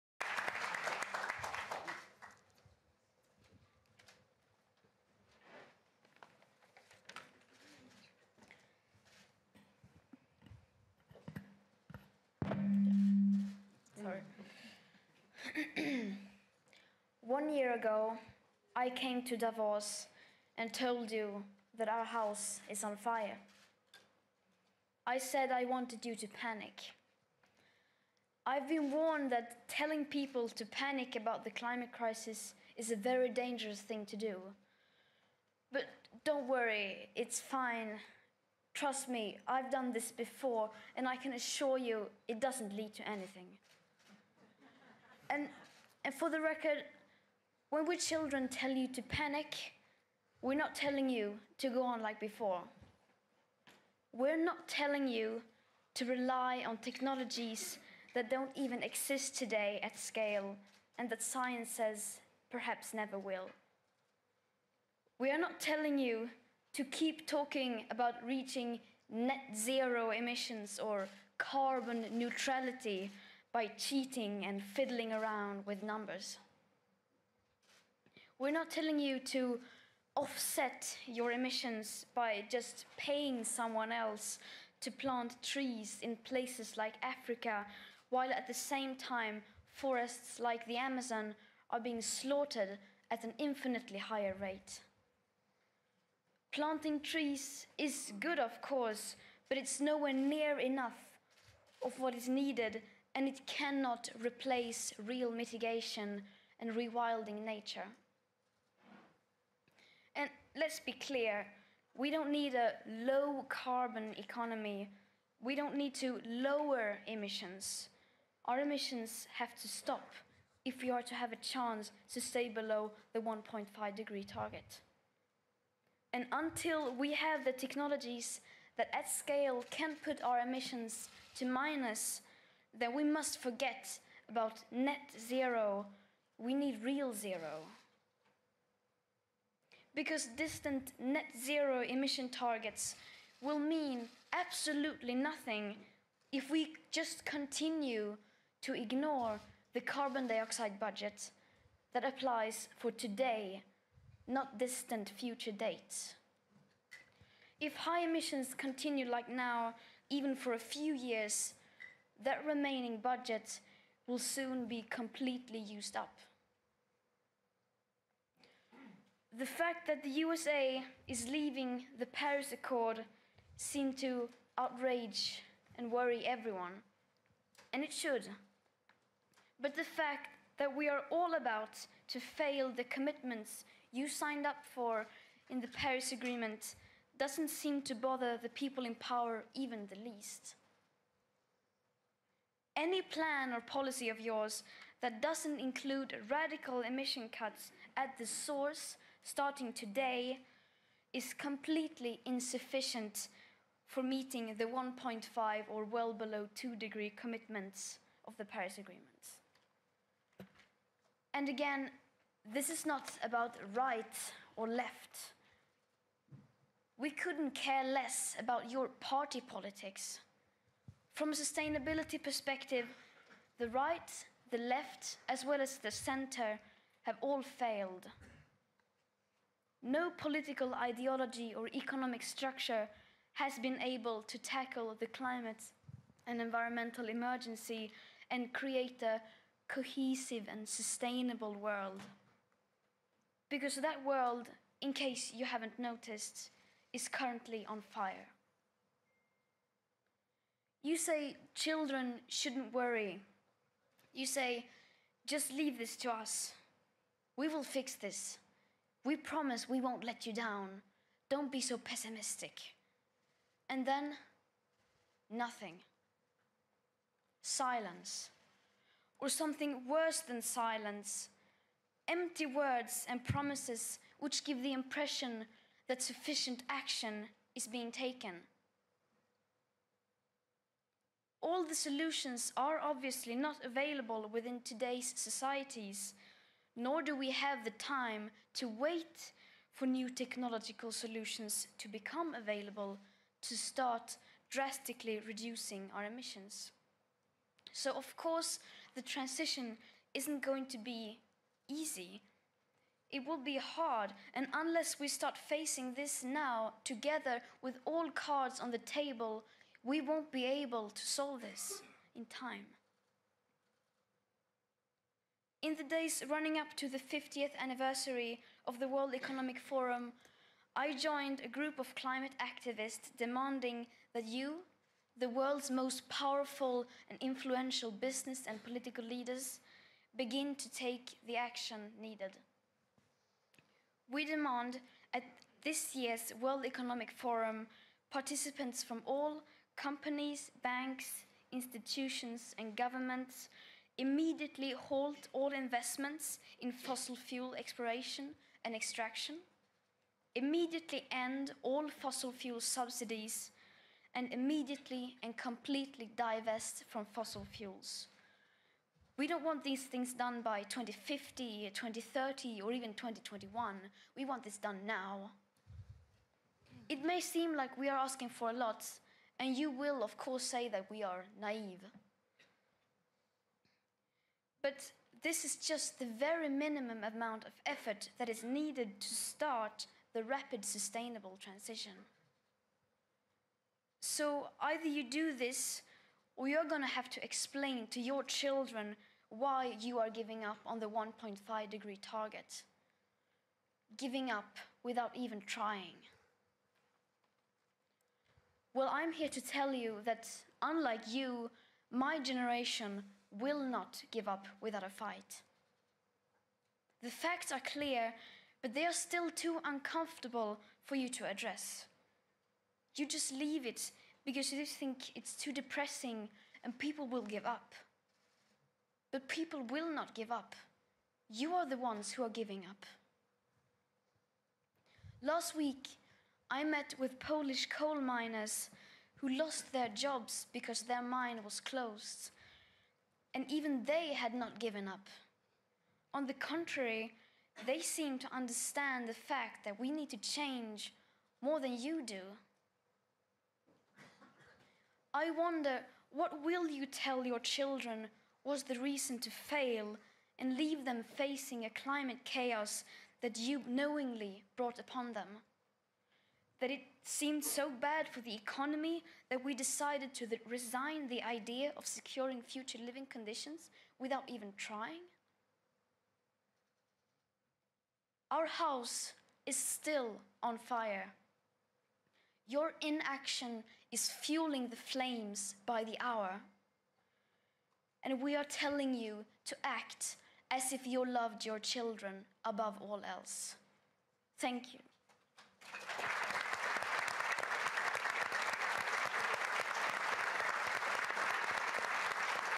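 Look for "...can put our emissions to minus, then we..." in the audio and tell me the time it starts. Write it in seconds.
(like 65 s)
129 s.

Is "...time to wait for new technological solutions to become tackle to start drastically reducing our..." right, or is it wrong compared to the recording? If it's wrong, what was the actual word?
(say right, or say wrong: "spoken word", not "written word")
wrong: "available", not "tackle".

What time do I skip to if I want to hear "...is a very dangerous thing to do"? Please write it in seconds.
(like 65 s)
32 s.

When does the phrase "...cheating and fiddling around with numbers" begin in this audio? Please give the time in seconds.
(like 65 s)
73 s.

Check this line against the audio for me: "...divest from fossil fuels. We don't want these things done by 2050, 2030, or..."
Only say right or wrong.
right.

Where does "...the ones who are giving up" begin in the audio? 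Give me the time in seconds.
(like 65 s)
421 s.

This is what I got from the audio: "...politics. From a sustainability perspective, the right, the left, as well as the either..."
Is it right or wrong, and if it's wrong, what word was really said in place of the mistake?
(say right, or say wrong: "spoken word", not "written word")
wrong: "center", not "either".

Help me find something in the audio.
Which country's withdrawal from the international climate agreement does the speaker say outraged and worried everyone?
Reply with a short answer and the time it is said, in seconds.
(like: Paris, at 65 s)
USA, at 170 s.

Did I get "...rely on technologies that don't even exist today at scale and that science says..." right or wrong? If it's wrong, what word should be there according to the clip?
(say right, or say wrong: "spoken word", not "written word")
right.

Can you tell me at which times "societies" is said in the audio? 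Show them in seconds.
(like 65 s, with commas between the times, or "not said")
285 s.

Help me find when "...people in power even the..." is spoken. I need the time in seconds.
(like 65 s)
188 s.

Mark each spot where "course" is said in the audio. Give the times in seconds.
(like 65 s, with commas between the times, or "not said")
98 s, 298 s, 370 s.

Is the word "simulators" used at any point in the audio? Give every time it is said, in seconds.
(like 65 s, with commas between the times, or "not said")
not said.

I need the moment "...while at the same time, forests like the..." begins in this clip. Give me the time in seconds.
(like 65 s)
88 s.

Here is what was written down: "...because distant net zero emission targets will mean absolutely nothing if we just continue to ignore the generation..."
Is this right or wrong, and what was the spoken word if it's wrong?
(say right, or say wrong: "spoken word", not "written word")
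wrong: "carbon", not "generation".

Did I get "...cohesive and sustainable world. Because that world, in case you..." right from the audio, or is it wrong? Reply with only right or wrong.
right.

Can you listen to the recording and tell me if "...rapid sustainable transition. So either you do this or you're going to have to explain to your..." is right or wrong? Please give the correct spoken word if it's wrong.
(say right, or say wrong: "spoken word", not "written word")
right.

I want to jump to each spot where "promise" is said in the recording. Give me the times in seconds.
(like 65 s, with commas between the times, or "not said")
259 s, 273 s.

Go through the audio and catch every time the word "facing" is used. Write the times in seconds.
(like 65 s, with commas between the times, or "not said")
305 s, 451 s.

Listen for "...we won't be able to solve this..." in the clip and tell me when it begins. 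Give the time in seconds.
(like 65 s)
309 s.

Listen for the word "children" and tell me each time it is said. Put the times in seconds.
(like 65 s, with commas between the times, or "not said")
47 s, 251 s, 388 s, 447 s, 481 s.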